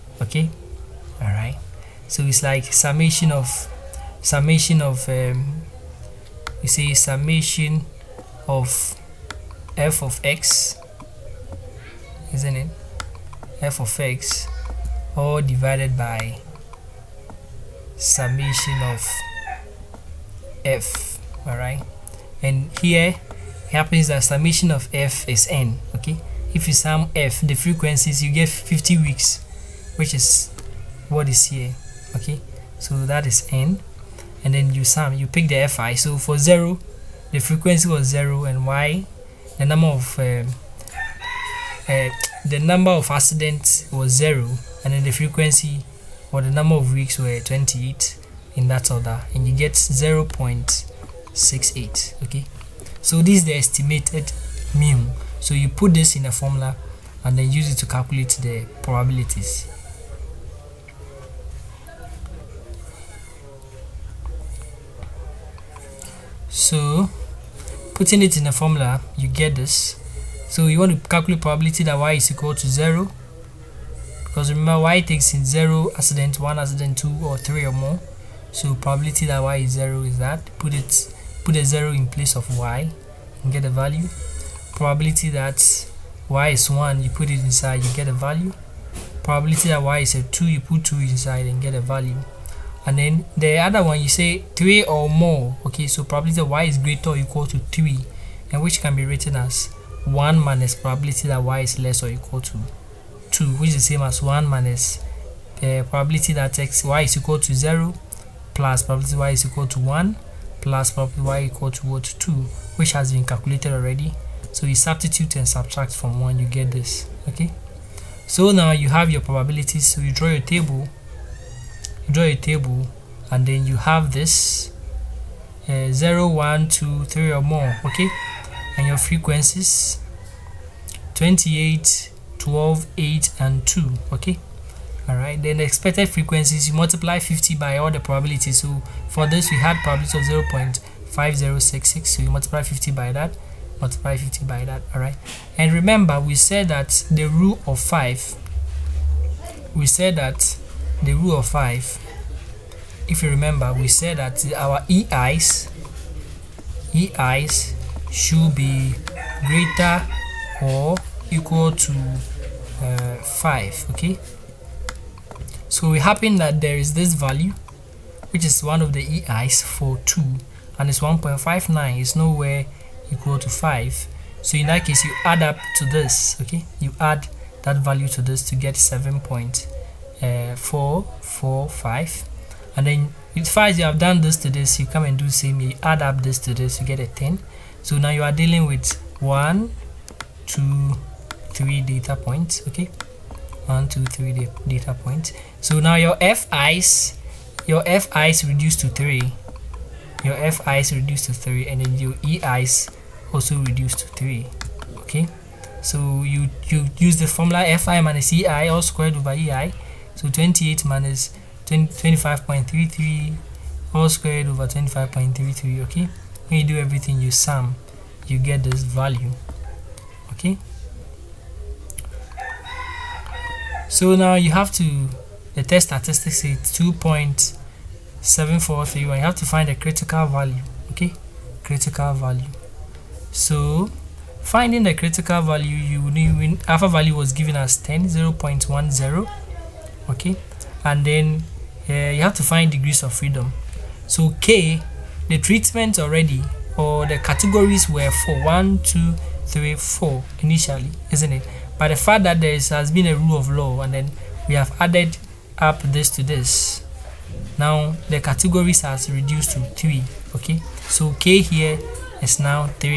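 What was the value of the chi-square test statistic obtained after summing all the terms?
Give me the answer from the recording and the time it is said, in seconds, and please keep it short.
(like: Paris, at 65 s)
2.743, at 226 s.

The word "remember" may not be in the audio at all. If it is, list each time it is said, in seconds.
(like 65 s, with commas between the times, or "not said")
74 s, 145 s, 153 s.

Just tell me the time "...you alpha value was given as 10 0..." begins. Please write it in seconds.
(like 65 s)
235 s.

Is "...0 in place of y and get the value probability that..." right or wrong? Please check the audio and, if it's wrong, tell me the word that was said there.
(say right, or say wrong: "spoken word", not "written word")
right.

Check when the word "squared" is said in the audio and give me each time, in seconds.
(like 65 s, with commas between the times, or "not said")
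208 s, 214 s.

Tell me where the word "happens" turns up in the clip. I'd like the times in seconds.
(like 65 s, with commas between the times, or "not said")
23 s, 165 s.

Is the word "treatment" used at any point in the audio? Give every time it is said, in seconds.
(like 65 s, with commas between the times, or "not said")
245 s.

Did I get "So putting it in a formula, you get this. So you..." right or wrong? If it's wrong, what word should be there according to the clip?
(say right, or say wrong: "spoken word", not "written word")
right.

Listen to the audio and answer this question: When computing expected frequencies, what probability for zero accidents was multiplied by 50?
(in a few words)
0.5066.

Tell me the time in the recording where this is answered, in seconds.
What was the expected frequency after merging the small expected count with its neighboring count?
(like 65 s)
178 s.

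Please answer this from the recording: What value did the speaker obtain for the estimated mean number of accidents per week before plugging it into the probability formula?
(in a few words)
0.68.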